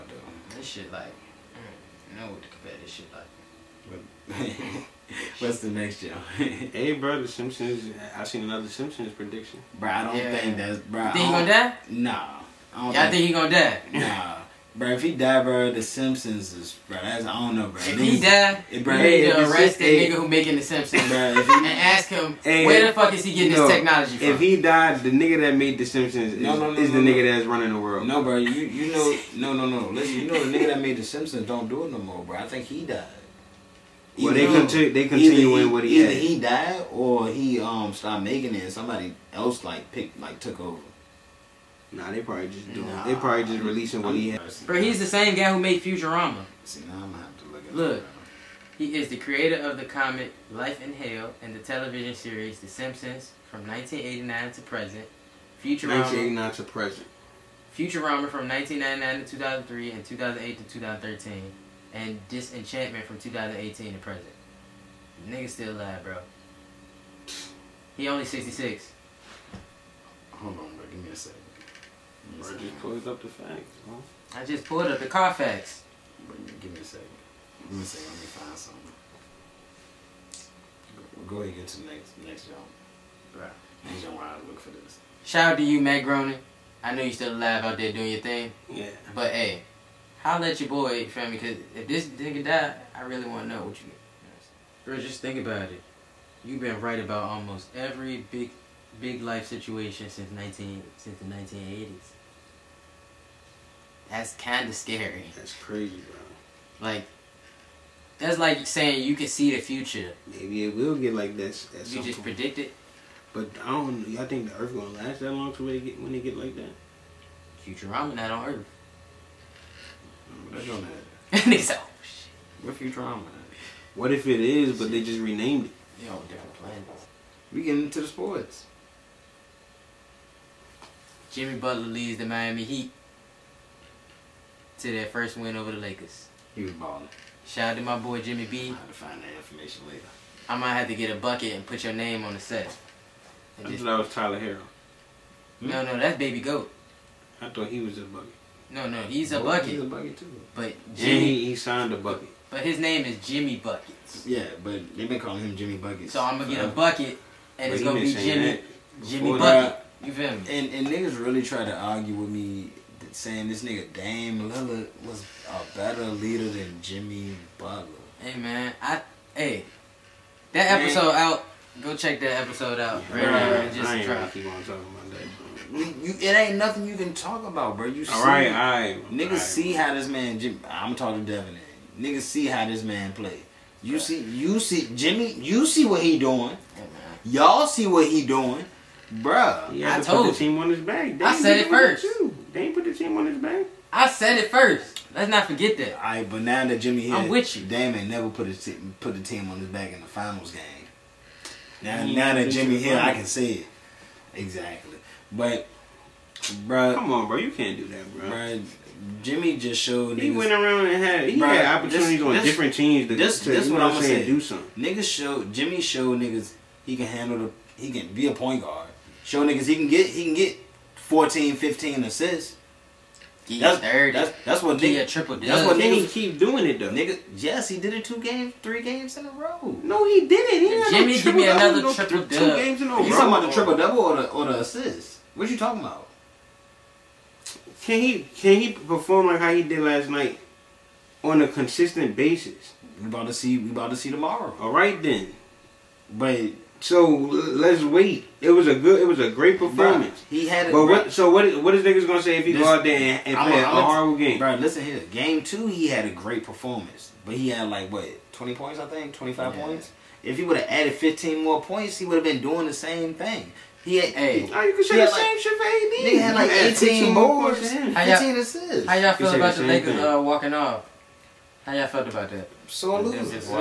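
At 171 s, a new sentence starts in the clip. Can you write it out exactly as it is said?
Go check that episode out right, right now.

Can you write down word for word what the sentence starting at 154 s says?
Yeah, but they've been calling him Jimmy Buckets.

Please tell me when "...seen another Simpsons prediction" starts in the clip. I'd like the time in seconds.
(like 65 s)
8 s.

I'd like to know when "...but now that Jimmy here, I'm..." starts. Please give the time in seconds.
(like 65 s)
196 s.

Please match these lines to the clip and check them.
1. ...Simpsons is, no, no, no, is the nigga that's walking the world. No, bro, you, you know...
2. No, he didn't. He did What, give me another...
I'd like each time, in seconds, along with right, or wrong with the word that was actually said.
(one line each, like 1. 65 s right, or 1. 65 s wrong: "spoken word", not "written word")
1. 25 s wrong: "running", not "walking"
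2. 229 s wrong: "Jimmy", not "What".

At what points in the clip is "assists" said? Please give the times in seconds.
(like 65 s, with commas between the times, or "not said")
222 s, 234 s, 268 s.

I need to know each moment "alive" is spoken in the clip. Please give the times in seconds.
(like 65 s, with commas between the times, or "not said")
65 s, 87 s.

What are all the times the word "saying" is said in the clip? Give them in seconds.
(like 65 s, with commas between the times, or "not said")
108 s, 163 s, 214 s.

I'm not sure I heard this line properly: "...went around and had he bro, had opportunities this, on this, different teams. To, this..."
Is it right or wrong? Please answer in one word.
right.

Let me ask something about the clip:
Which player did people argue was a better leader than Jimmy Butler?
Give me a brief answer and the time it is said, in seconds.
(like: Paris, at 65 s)
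Dame Lillard, at 163 s.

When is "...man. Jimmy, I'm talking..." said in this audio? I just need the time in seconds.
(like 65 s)
180 s.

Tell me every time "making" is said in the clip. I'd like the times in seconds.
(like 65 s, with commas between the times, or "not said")
20 s, 38 s.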